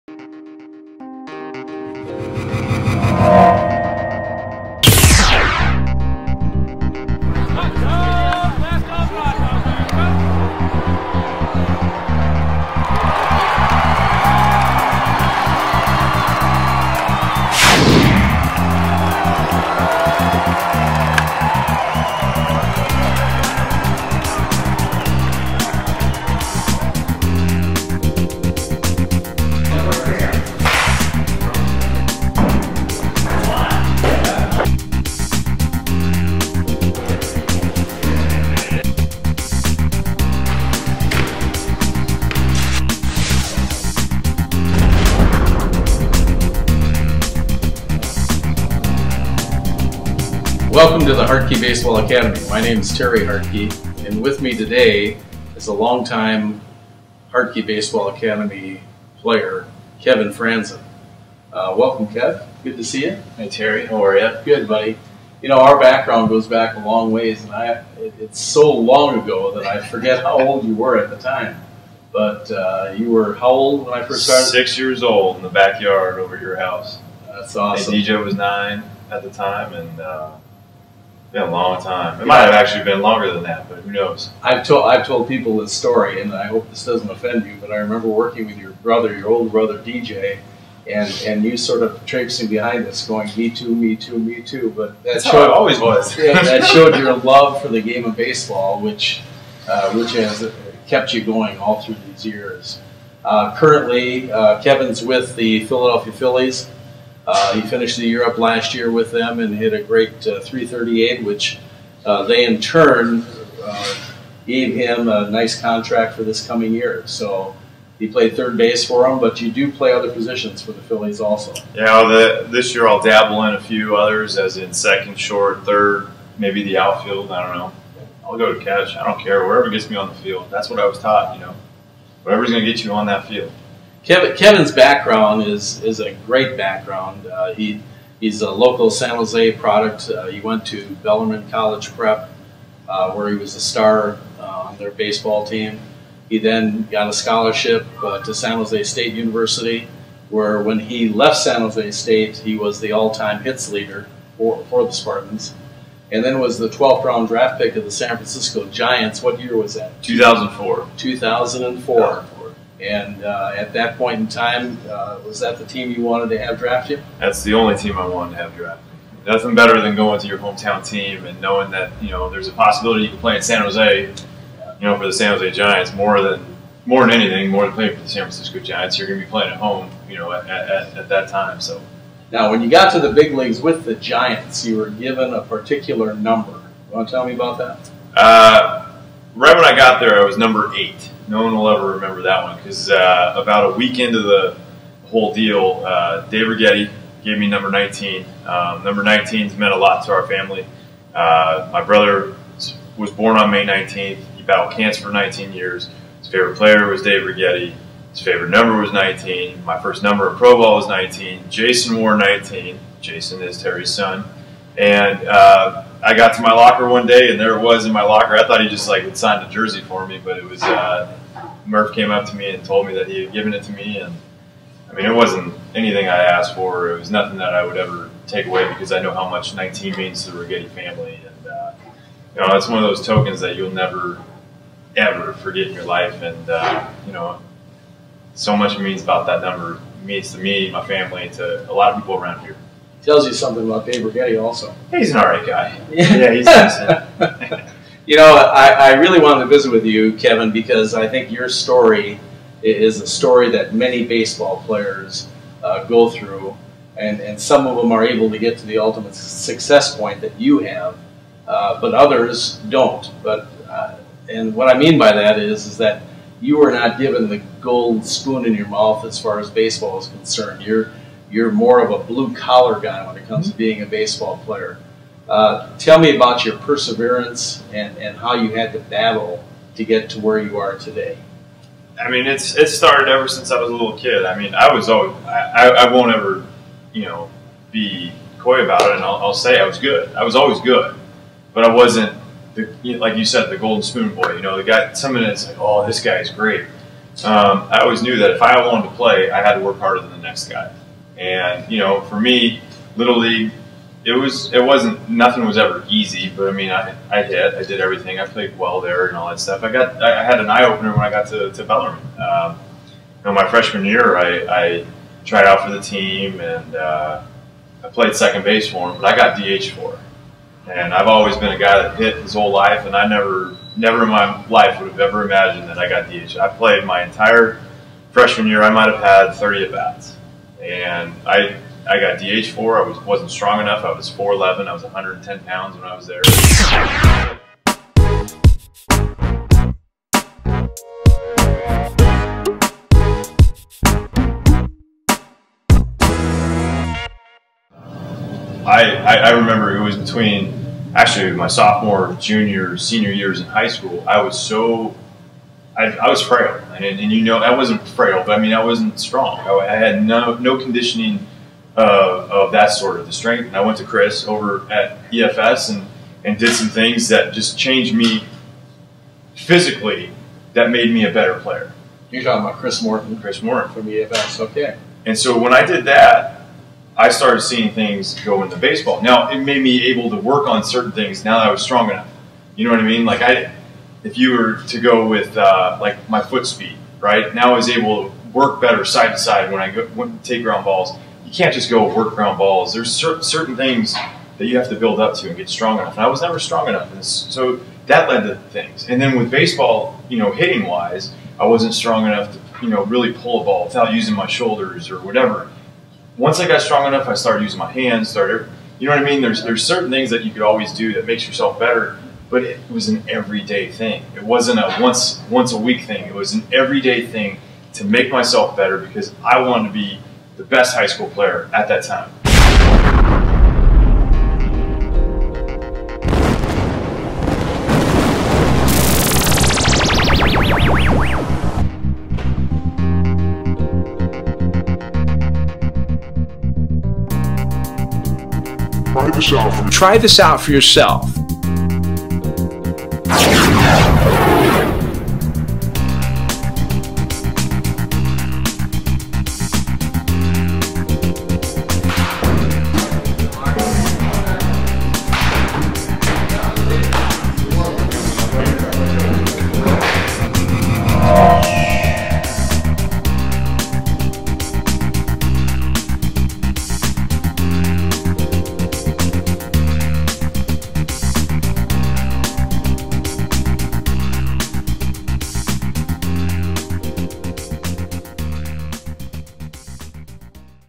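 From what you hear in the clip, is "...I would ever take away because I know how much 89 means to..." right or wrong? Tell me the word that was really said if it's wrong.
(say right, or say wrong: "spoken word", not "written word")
wrong: "19", not "89".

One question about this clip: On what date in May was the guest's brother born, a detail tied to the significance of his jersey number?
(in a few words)
May 19th.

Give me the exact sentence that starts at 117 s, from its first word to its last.
So he played third base for them, but you do play other positions for the Phillies also.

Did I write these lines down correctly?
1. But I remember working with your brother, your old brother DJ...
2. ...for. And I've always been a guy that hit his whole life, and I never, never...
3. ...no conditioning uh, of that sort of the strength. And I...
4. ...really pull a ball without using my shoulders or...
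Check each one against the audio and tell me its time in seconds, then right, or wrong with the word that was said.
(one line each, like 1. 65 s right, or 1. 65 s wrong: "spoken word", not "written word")
1. 87 s right
2. 319 s right
3. 360 s right
4. 402 s right.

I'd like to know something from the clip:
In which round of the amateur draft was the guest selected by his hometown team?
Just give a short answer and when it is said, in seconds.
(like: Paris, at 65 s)
12th round, at 156 s.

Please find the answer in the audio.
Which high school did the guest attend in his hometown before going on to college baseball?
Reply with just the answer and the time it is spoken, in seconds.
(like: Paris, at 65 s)
Bellarmine College Prep, at 141 s.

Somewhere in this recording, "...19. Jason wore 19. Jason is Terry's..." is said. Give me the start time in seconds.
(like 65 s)
210 s.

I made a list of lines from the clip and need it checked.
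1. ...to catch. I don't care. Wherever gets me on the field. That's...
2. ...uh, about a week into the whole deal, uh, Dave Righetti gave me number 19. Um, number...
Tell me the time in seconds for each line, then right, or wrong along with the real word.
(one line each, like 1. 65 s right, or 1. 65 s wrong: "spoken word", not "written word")
1. 128 s right
2. 192 s right.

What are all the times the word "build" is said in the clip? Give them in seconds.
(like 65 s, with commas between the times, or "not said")
394 s.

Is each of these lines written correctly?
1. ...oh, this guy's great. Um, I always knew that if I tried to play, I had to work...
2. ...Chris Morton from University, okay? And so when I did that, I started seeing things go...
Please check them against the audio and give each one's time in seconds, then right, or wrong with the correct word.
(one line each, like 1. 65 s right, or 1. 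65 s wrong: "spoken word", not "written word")
1. 295 s wrong: "wanted", not "tried"
2. 373 s wrong: "EFS", not "University".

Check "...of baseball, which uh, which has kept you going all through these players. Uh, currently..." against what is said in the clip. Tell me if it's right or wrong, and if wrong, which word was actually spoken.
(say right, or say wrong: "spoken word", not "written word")
wrong: "years", not "players".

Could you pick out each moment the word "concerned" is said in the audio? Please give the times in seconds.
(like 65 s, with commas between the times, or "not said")
270 s.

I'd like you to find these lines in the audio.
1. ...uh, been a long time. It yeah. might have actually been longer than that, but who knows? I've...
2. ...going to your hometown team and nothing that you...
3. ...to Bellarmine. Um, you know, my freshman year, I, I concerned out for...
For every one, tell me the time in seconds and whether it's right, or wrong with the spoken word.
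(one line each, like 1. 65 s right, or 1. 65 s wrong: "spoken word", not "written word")
1. 79 s right
2. 169 s wrong: "knowing", not "nothing"
3. 311 s wrong: "tried", not "concerned".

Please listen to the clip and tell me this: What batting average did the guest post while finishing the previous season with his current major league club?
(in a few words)
.338.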